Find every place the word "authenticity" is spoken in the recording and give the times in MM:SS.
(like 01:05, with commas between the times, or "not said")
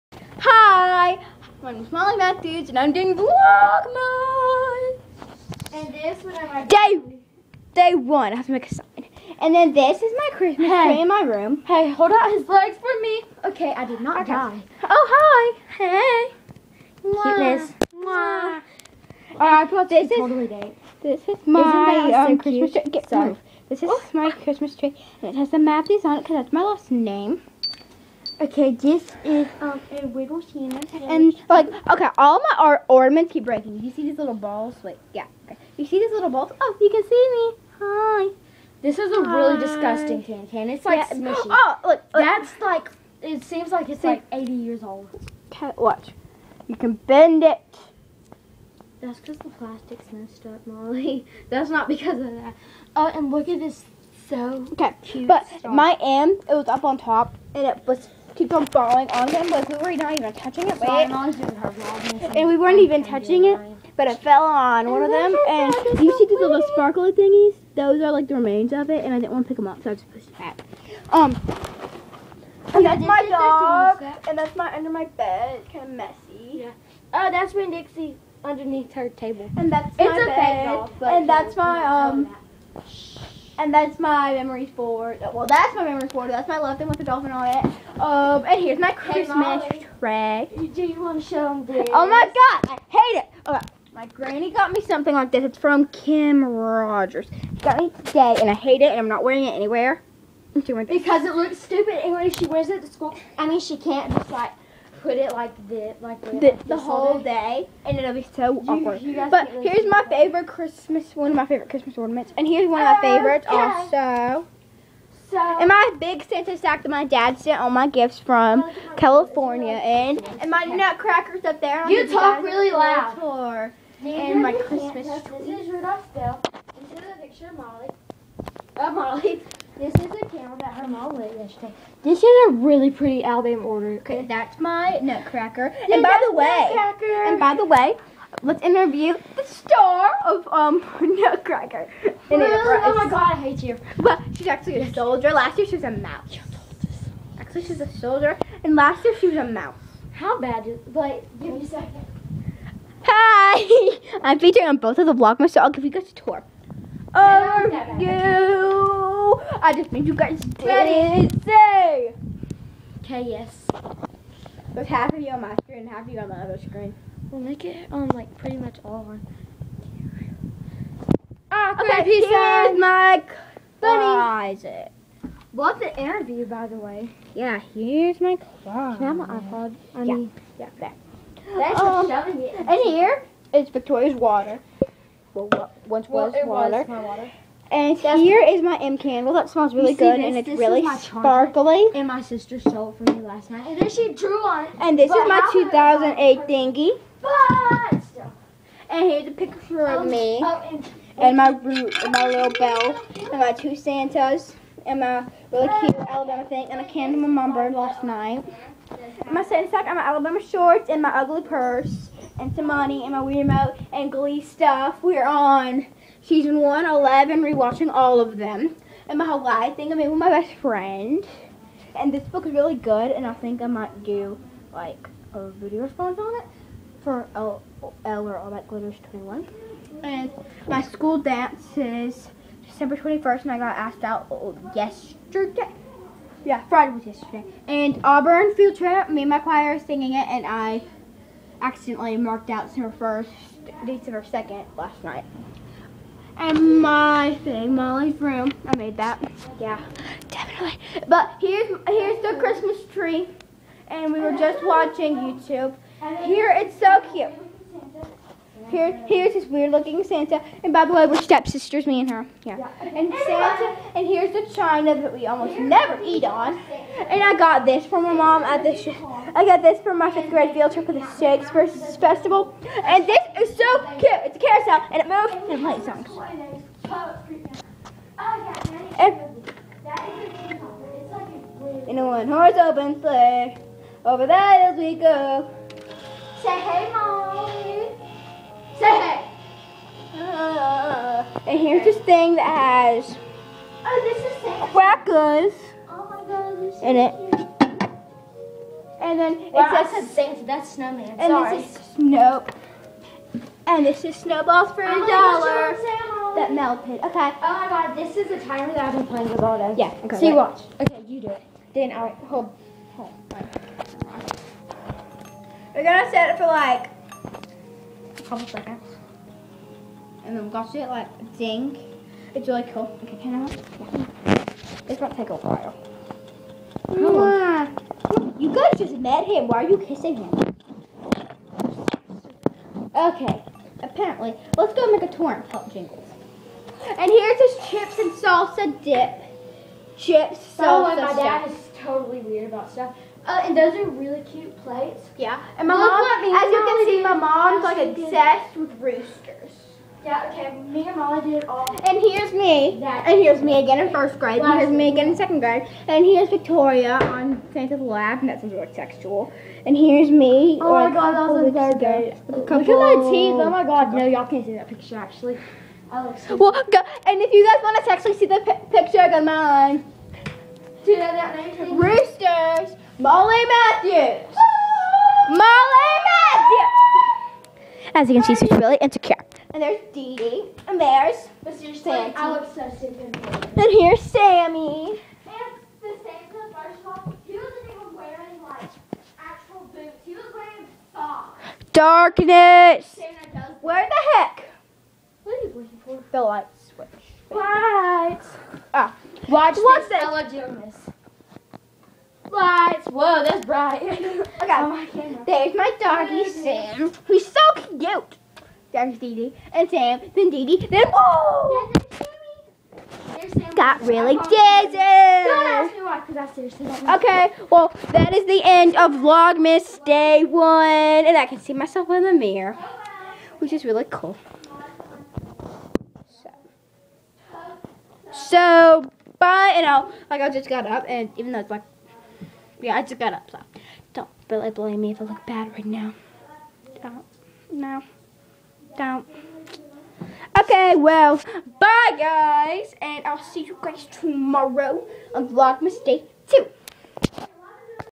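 not said.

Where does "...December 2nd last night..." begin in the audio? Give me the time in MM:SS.
04:03.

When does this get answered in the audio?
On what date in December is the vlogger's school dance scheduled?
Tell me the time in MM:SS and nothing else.
03:52.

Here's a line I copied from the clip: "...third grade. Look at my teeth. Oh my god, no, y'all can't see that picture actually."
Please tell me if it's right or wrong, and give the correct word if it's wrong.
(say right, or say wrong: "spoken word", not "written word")
right.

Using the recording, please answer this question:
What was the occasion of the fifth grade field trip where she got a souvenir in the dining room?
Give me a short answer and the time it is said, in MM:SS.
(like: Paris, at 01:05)
Shakespeare Festival, at 04:31.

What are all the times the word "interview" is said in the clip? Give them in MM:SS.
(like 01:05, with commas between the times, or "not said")
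02:18, 02:55.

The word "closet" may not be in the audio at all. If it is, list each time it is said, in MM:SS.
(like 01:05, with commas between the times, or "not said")
02:53, 02:58.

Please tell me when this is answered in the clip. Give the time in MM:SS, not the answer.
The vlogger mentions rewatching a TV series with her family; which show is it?
03:34.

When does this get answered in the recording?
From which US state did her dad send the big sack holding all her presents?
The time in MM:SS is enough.
01:58.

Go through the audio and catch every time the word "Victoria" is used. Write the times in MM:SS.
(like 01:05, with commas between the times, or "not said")
03:03, 05:56.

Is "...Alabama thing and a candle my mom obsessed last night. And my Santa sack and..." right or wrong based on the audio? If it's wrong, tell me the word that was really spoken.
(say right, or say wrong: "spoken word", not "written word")
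wrong: "burned", not "obsessed".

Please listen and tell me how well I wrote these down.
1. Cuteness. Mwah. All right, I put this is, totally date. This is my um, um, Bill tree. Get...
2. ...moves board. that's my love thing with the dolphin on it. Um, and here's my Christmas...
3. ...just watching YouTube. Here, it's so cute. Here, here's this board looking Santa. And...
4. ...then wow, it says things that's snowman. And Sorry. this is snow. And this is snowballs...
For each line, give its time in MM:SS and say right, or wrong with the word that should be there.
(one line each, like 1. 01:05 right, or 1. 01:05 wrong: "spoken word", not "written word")
1. 00:17 wrong: "Christmas", not "Bill"
2. 01:25 wrong: "memories", not "moves"
3. 04:14 wrong: "weird", not "board"
4. 04:59 right.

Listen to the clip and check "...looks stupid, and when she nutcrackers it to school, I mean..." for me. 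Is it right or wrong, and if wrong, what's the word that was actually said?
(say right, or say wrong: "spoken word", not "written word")
wrong: "wears", not "nutcrackers".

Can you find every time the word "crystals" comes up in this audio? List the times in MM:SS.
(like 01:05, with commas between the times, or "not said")
not said.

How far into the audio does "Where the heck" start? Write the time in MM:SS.
06:33.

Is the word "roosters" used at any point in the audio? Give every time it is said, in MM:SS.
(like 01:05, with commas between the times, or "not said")
05:48, 06:11.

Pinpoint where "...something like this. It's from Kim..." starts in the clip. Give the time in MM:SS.
01:34.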